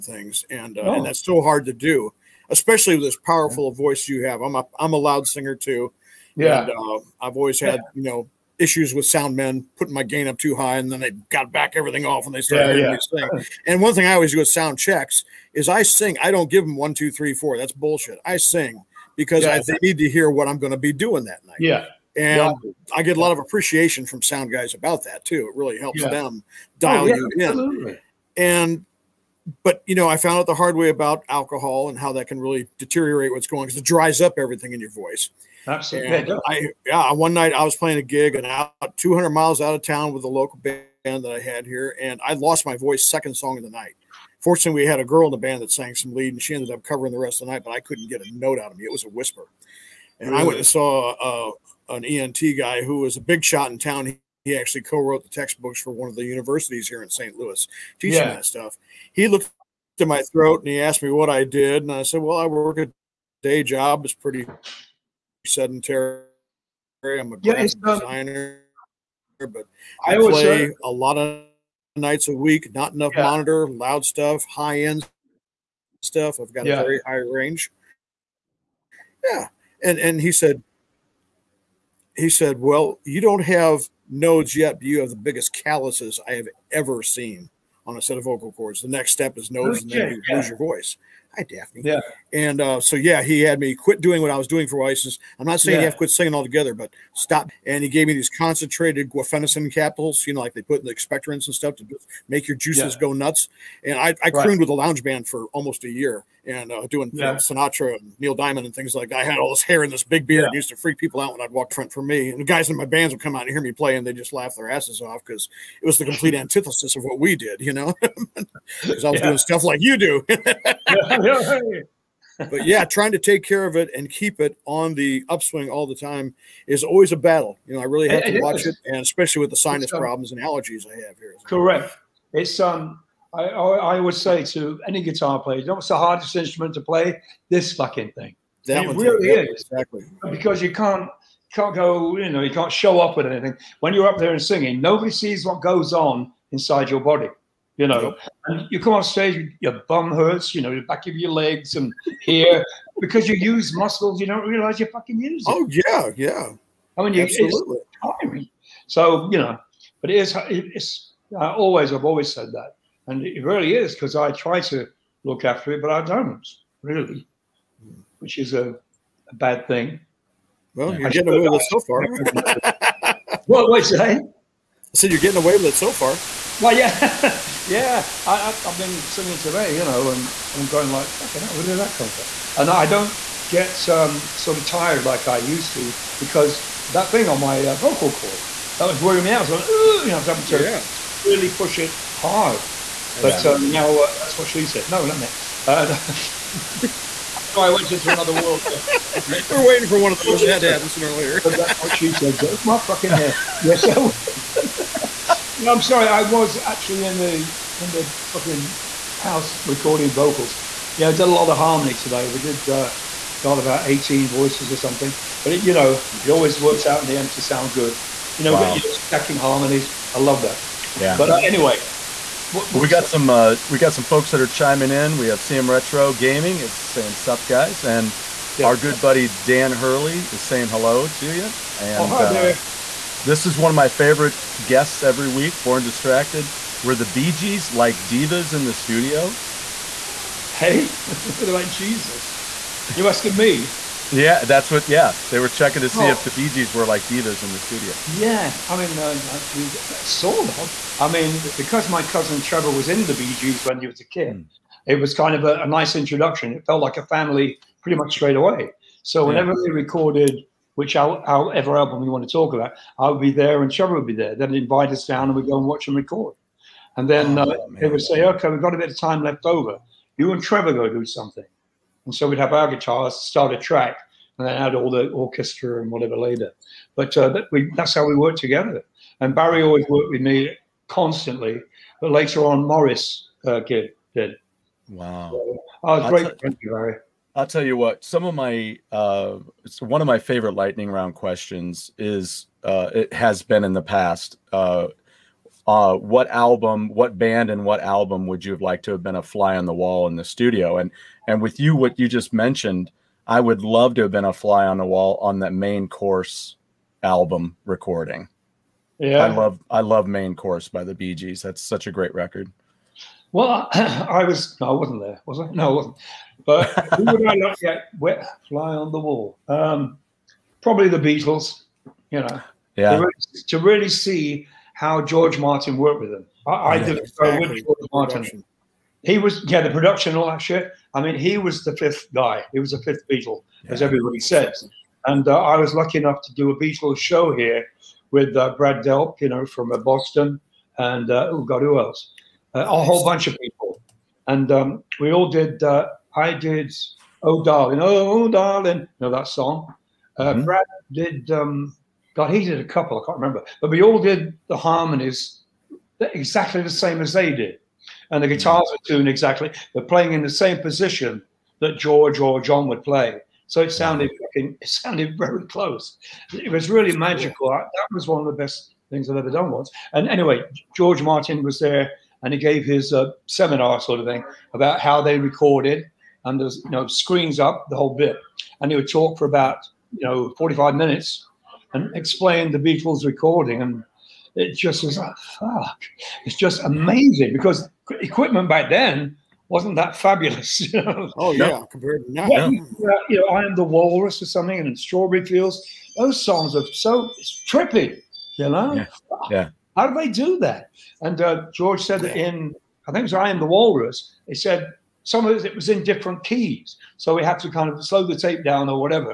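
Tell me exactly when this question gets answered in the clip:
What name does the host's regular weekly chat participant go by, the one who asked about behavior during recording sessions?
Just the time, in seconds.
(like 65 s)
235 s.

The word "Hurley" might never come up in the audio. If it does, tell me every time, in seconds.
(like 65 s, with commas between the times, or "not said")
229 s.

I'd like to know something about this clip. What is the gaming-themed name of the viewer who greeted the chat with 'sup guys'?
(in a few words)
CM Retro Gaming.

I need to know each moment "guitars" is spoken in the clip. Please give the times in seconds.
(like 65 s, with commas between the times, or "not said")
135 s, 272 s, 358 s.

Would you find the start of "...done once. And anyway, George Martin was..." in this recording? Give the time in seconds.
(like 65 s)
369 s.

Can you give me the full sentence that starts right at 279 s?
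And Barry always worked with me constantly.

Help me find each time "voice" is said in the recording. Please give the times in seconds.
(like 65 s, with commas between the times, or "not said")
3 s, 34 s, 42 s, 90 s, 214 s.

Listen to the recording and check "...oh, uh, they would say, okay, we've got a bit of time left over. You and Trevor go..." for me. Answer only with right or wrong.
right.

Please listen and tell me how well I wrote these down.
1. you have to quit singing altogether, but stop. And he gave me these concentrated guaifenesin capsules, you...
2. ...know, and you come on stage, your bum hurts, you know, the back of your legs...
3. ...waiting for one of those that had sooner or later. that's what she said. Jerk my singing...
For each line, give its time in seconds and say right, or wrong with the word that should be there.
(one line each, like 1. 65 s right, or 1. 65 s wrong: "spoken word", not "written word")
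1. 95 s right
2. 147 s right
3. 199 s wrong: "fucking", not "singing".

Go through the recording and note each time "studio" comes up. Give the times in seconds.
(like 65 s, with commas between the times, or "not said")
238 s, 247 s, 300 s.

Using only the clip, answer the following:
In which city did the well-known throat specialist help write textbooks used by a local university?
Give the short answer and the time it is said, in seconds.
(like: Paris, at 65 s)
St. Louis, at 57 s.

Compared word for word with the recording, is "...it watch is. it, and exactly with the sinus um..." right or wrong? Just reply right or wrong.
wrong.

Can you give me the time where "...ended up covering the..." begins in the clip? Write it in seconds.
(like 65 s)
46 s.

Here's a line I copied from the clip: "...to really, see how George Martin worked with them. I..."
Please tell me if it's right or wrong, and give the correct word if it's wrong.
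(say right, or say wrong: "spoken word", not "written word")
right.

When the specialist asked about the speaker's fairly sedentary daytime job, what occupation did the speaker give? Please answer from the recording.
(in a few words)
Designer.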